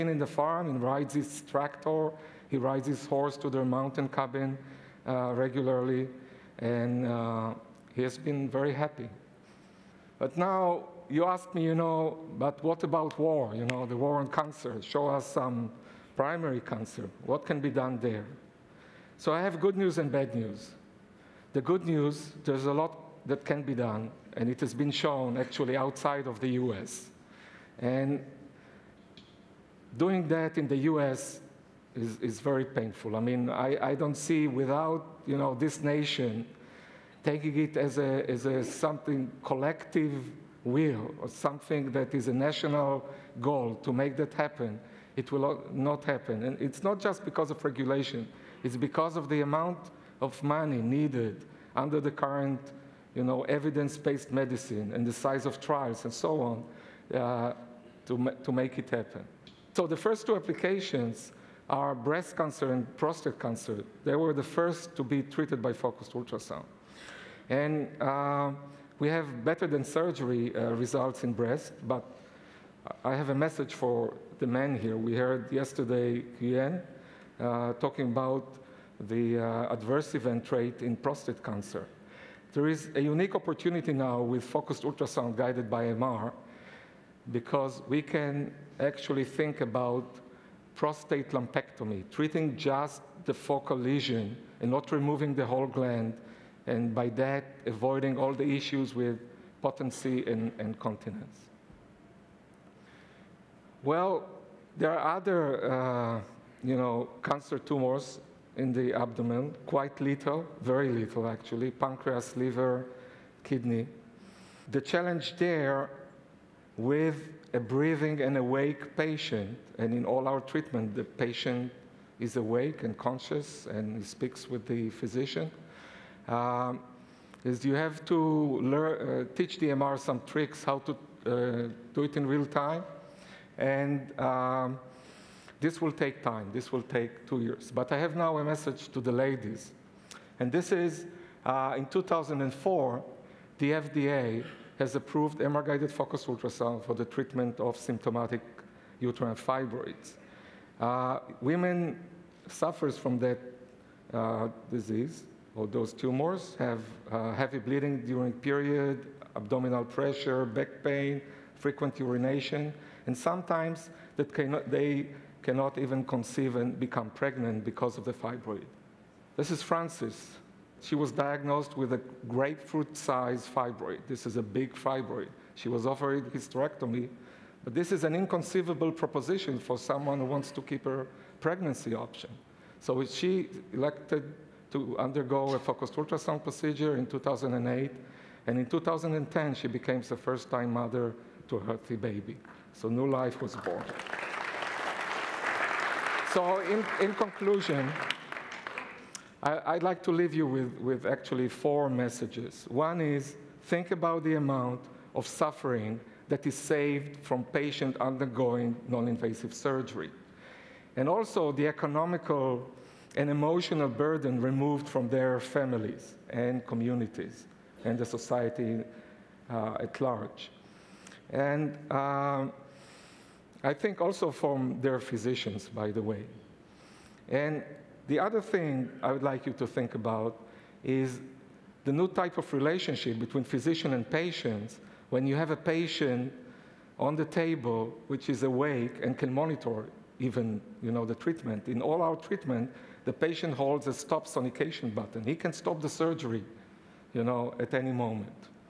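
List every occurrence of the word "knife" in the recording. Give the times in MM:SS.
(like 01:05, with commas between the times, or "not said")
not said.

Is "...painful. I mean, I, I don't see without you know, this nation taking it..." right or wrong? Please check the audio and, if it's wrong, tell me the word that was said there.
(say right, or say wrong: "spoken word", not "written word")
right.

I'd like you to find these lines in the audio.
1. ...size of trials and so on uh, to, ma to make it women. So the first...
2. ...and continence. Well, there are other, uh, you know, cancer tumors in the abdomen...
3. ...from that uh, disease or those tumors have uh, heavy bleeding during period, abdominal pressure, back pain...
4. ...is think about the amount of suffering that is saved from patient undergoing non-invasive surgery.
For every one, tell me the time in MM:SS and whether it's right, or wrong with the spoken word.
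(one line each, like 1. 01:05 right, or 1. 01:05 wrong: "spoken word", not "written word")
1. 00:55 wrong: "happen", not "women"
2. 01:40 right
3. 02:32 right
4. 03:23 right.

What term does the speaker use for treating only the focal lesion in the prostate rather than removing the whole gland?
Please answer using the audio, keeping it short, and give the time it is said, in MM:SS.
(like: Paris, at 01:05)
prostate lumpectomy, at 01:30.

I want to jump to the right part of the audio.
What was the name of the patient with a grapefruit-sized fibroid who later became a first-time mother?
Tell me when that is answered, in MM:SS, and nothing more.
02:49.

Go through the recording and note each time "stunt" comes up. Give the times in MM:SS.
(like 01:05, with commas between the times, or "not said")
not said.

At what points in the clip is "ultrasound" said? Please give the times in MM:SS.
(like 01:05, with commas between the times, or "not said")
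01:06, 01:24, 02:26, 03:05.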